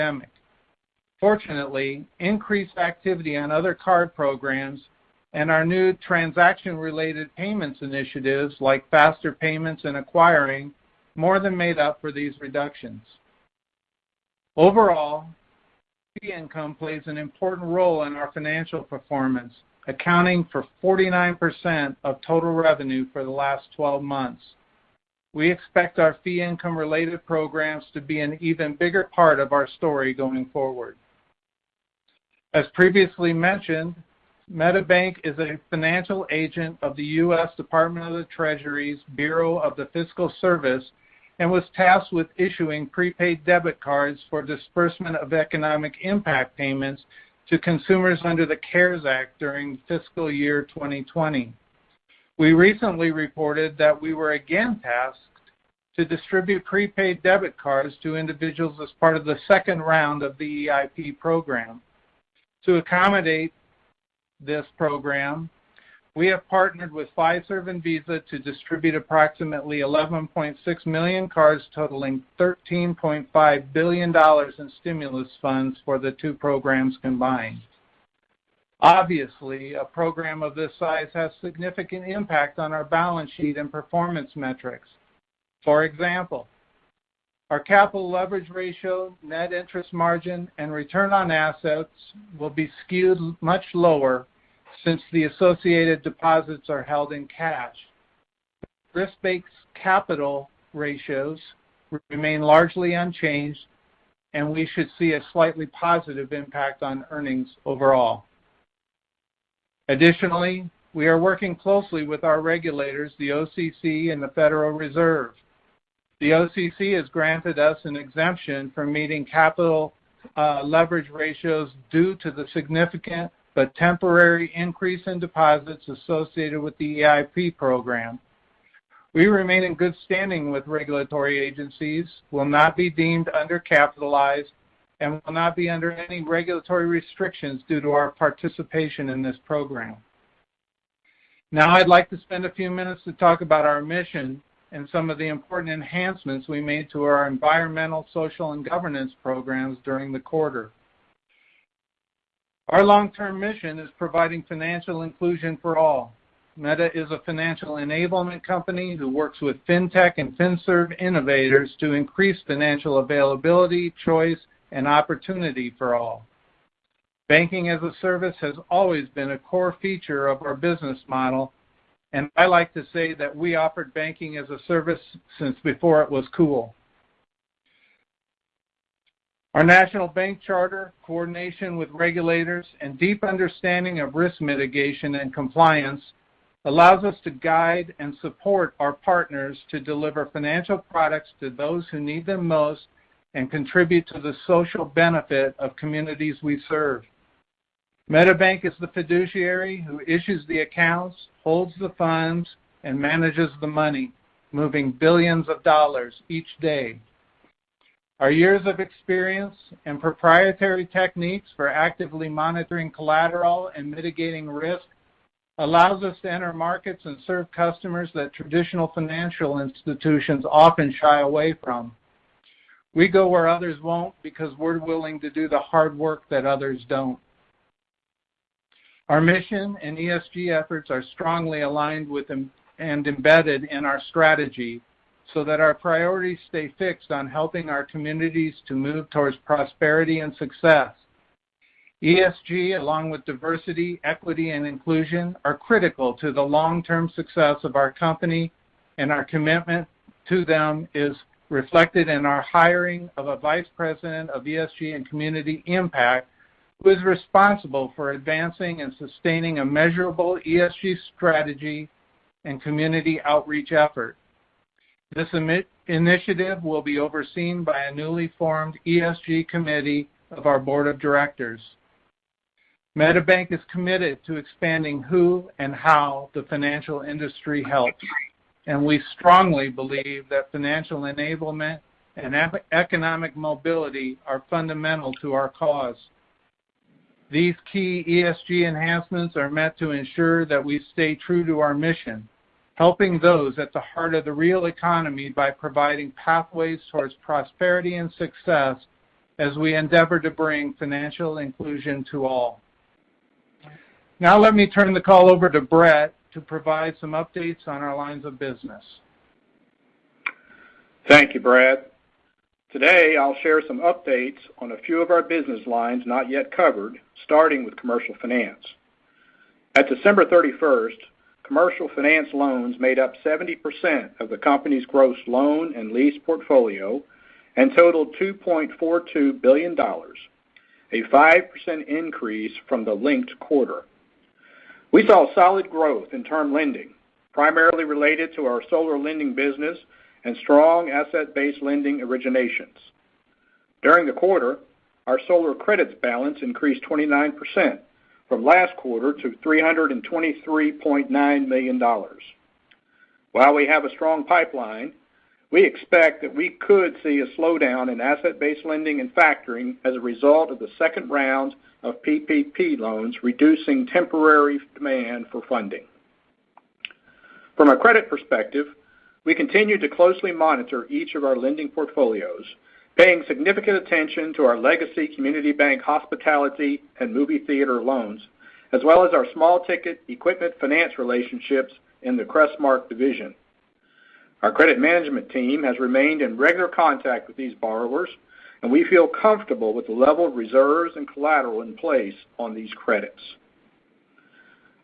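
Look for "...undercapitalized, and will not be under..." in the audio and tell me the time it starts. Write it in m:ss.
2:13.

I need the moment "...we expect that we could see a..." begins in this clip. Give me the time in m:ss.
5:55.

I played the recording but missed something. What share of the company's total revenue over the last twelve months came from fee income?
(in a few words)
49%.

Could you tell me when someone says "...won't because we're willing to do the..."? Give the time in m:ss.
3:43.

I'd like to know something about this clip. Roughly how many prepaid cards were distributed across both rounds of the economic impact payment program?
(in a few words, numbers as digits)
11.6 million.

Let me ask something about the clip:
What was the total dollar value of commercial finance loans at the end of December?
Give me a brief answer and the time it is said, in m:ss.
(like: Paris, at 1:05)
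$2.42 billion, at 5:28.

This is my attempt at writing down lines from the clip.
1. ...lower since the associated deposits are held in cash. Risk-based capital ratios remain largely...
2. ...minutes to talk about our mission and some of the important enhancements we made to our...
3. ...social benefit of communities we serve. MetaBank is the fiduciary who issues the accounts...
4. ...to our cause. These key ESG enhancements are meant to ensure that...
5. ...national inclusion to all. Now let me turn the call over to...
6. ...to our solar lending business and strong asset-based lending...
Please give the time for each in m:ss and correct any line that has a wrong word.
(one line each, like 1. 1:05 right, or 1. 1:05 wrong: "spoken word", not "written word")
1. 1:33 right
2. 2:22 right
3. 3:14 right
4. 4:45 right
5. 5:00 wrong: "financial", not "national"
6. 5:38 right.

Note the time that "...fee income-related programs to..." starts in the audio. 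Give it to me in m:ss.
0:26.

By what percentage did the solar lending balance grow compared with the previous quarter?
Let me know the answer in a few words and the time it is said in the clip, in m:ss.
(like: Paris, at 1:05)
29%, at 5:46.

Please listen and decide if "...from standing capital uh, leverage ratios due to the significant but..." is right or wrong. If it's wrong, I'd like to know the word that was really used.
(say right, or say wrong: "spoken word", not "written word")
wrong: "meeting", not "standing".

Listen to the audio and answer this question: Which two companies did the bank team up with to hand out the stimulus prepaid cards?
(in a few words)
Fiserv and Visa.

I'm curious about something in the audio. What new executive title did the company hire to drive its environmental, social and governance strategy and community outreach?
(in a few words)
Vice President of ESG and Community Impact.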